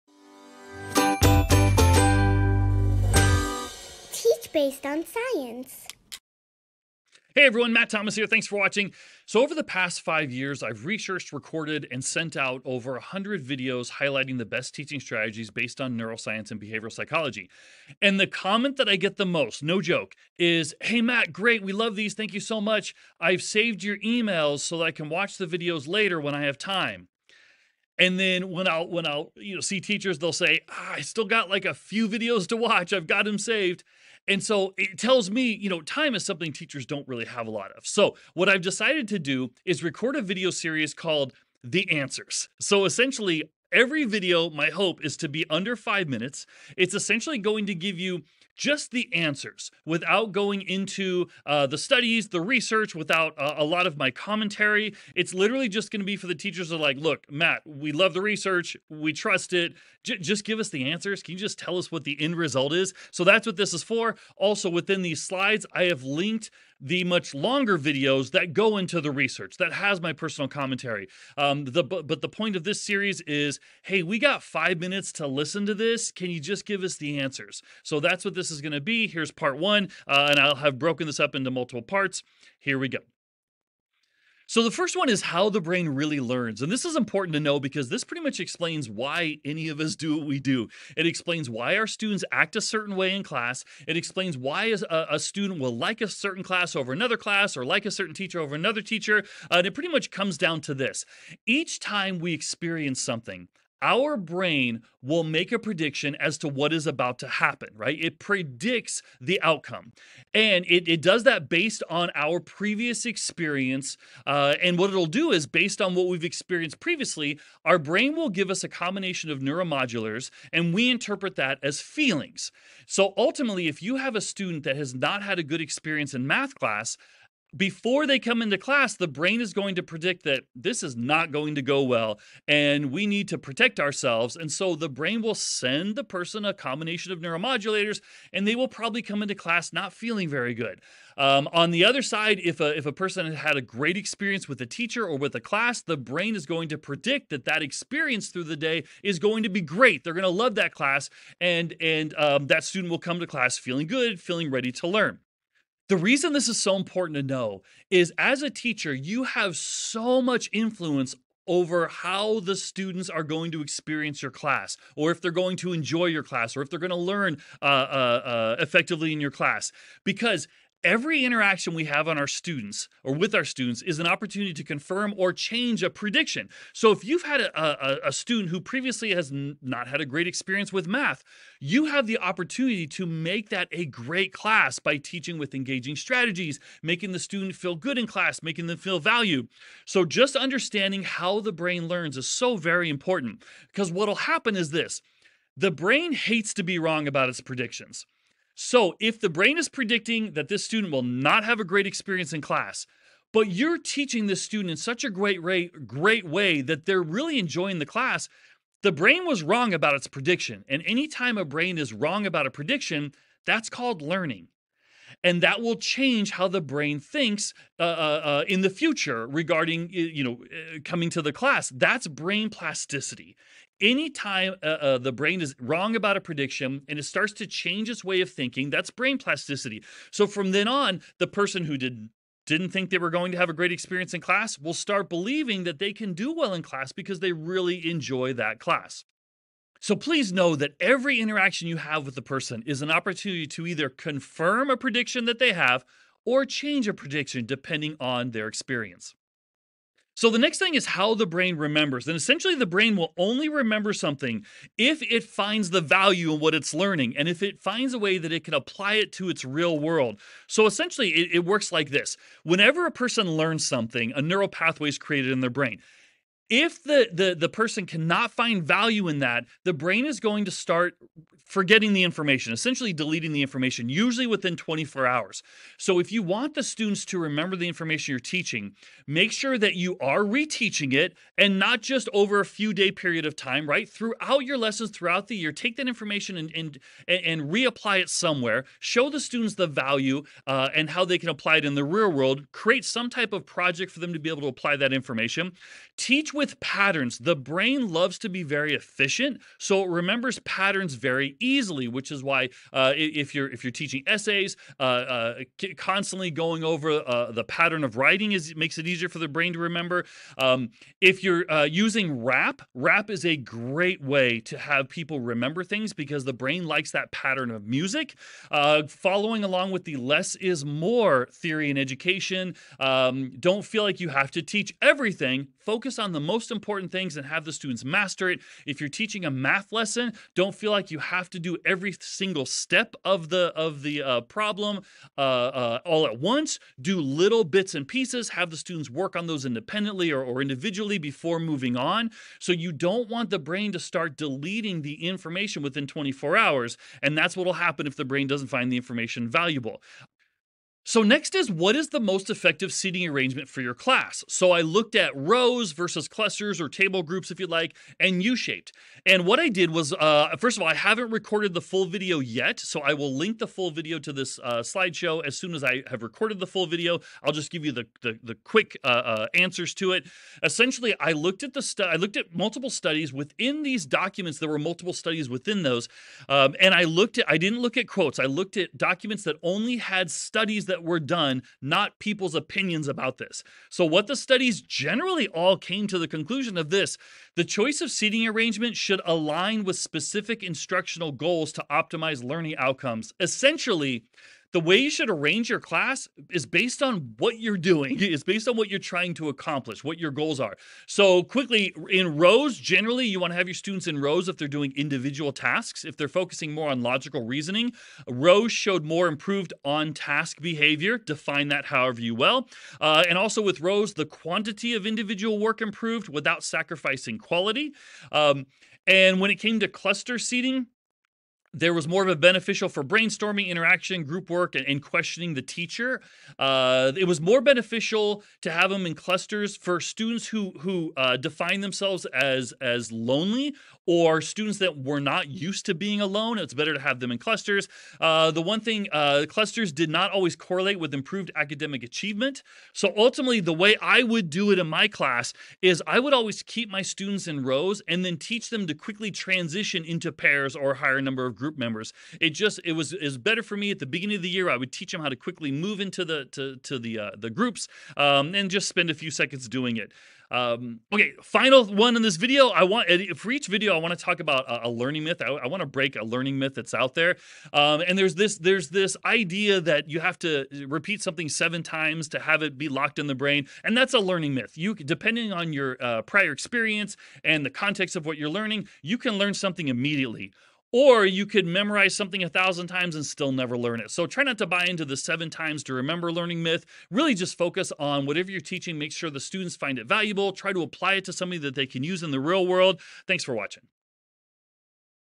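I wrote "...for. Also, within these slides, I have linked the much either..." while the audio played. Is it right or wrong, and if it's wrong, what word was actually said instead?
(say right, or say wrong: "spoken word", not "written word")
wrong: "longer", not "either".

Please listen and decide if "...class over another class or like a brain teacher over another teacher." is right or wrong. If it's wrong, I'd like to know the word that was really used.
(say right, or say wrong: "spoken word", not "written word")
wrong: "certain", not "brain".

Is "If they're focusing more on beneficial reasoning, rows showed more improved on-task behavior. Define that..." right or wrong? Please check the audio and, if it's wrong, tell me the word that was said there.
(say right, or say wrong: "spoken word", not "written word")
wrong: "logical", not "beneficial".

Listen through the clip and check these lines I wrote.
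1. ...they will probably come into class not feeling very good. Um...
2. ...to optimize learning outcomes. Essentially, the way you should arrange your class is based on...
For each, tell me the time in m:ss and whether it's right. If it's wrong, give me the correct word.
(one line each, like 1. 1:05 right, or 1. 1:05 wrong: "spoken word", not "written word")
1. 2:18 right
2. 6:31 right.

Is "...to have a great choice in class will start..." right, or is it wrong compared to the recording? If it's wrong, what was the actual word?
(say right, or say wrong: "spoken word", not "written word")
wrong: "experience", not "choice".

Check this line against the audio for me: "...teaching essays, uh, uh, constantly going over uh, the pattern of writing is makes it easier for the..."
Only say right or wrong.
right.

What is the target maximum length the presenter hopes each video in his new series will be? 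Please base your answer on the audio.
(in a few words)
under five minutes.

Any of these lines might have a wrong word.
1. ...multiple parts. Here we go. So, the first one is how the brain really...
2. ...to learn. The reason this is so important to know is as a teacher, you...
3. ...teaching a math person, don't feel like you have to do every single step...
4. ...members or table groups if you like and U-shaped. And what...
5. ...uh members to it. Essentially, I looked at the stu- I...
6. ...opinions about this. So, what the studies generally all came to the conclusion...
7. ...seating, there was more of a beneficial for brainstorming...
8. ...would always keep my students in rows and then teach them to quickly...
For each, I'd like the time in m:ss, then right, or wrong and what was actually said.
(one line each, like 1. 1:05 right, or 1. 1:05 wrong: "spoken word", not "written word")
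1. 1:21 right
2. 2:34 right
3. 5:29 wrong: "lesson", not "person"
4. 5:56 wrong: "clusters", not "members"
5. 6:08 wrong: "answers", not "members"
6. 6:22 right
7. 7:00 right
8. 7:25 right.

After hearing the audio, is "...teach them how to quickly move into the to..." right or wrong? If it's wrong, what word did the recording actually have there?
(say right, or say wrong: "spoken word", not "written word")
right.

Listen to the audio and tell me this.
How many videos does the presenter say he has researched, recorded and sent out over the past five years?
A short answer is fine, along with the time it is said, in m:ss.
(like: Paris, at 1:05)
over 100, at 0:12.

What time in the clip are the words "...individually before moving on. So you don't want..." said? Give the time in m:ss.
5:40.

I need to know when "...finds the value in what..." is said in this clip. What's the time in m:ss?
4:15.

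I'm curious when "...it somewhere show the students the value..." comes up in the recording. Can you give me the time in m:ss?
4:47.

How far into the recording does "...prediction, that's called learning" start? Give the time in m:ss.
3:32.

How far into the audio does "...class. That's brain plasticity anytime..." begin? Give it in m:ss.
3:41.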